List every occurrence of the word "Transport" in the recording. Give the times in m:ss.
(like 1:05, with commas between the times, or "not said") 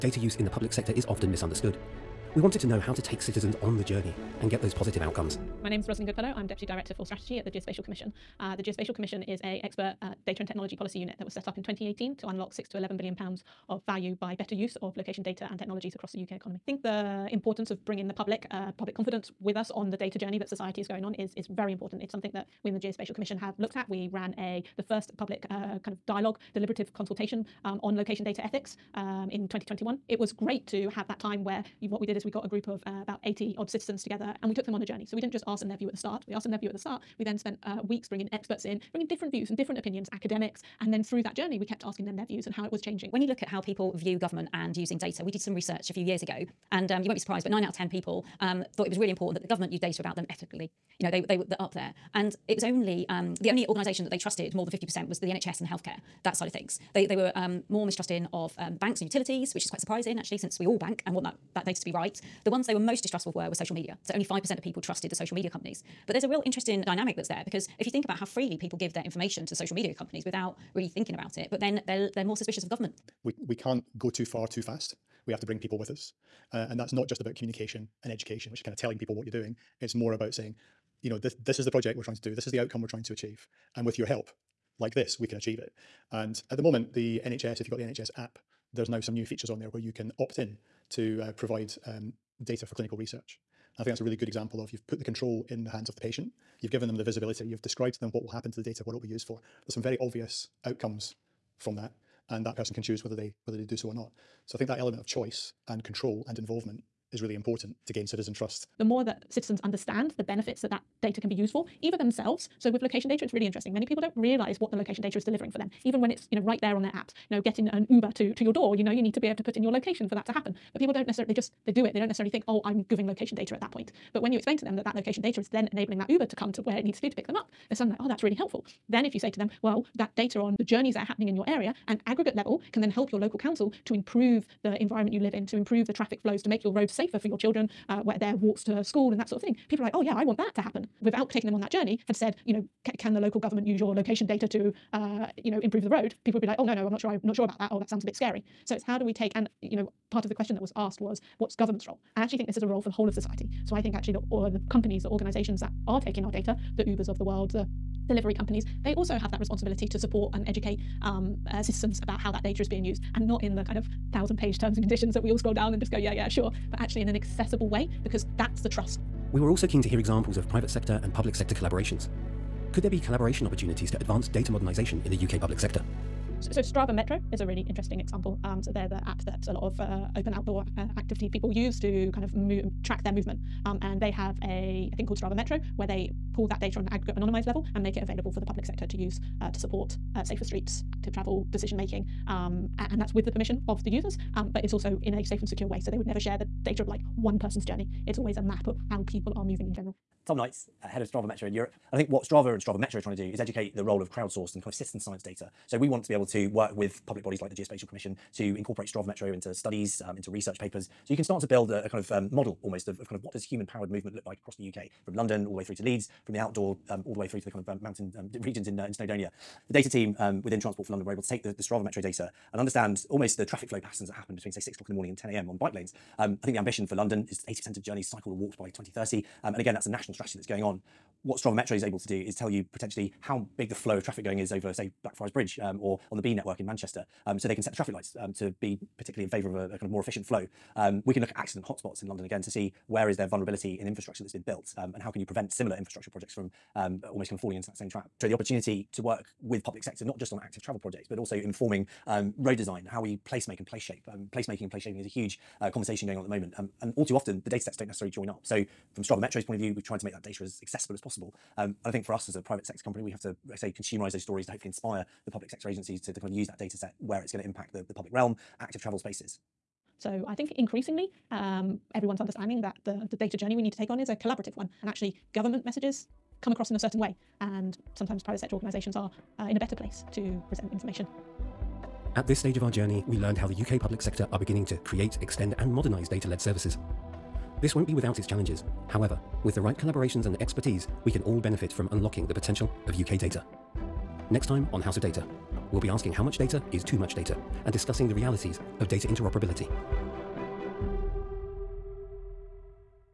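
3:40.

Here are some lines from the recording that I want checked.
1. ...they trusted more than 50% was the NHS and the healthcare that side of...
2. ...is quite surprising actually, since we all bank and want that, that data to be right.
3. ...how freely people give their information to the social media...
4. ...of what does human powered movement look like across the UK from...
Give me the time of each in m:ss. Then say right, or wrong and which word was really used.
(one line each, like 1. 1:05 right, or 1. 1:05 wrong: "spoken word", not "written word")
1. 0:54 right
2. 0:59 right
3. 1:08 right
4. 3:33 right.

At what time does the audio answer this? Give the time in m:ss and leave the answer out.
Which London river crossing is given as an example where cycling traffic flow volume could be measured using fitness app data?
3:55.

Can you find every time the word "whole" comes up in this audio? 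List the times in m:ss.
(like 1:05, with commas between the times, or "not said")
2:32.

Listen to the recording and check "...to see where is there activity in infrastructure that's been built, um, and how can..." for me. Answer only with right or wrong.
wrong.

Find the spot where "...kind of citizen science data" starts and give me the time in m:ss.
3:24.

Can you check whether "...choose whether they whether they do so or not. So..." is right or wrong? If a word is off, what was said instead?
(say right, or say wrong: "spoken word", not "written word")
right.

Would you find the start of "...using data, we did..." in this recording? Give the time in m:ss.
0:44.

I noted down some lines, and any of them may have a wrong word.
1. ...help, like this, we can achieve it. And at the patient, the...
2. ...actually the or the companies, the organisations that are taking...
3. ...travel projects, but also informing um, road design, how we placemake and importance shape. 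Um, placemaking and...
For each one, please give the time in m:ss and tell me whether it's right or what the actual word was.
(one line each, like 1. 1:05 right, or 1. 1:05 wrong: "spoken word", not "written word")
1. 1:24 wrong: "moment", not "patient"
2. 2:33 right
3. 4:10 wrong: "place", not "importance".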